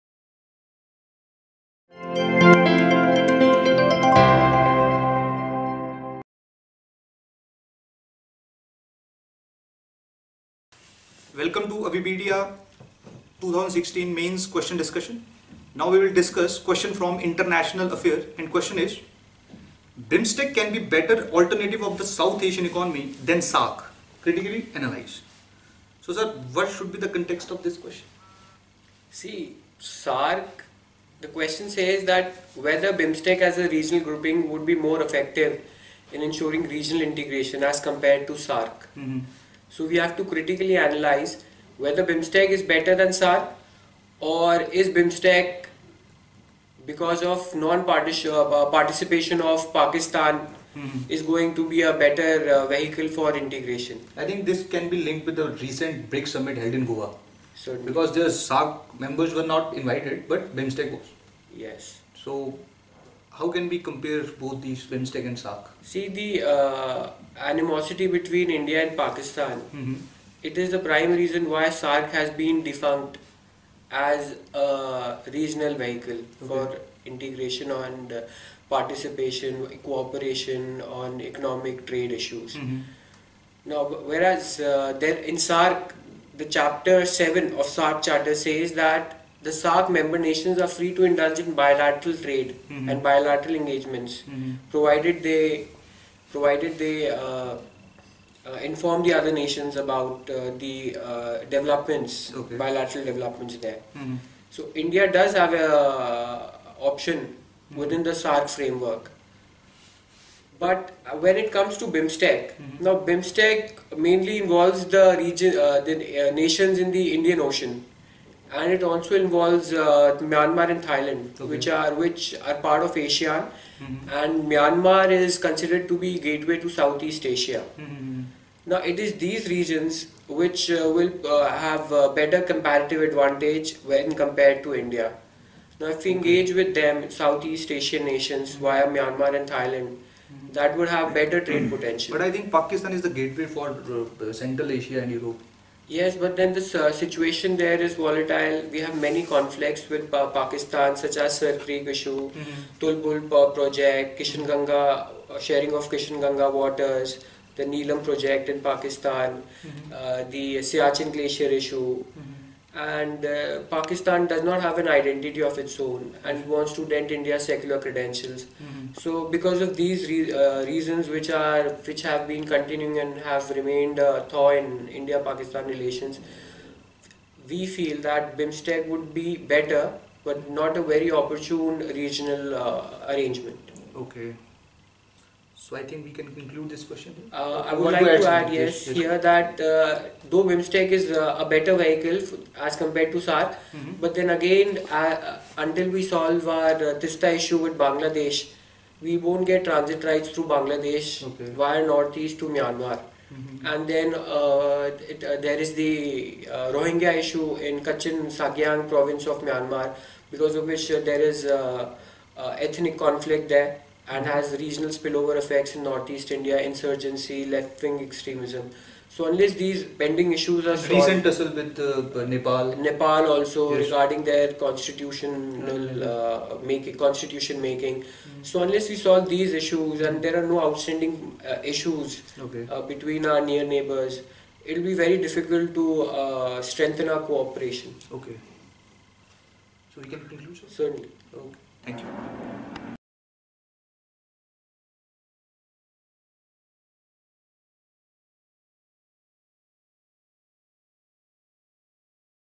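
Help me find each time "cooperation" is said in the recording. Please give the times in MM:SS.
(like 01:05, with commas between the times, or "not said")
01:19, 03:57.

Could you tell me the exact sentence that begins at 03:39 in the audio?
So unless these pending issues are solved, recent tussle with uh, Nepal, Nepal also yes.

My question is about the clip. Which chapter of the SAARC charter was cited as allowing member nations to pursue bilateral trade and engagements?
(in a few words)
Chapter 7.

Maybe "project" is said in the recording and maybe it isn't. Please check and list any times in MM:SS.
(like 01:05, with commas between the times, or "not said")
02:33, 02:38.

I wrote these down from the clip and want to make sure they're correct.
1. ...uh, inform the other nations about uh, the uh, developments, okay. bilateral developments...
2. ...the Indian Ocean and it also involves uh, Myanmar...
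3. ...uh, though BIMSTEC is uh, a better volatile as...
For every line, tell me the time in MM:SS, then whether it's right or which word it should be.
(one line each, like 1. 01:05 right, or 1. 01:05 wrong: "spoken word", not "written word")
1. 01:38 right
2. 01:56 right
3. 03:09 wrong: "vehicle", not "volatile".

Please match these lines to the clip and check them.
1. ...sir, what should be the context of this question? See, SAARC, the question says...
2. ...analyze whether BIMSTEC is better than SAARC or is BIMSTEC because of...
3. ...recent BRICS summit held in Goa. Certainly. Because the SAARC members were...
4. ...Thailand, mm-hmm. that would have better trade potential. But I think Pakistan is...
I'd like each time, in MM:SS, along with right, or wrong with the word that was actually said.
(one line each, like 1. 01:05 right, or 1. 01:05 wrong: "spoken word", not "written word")
1. 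00:26 right
2. 00:40 right
3. 00:55 right
4. 02:19 right.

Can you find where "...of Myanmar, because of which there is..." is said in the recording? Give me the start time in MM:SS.
03:29.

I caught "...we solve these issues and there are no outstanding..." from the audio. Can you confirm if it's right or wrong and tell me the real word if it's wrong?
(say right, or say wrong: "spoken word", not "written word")
right.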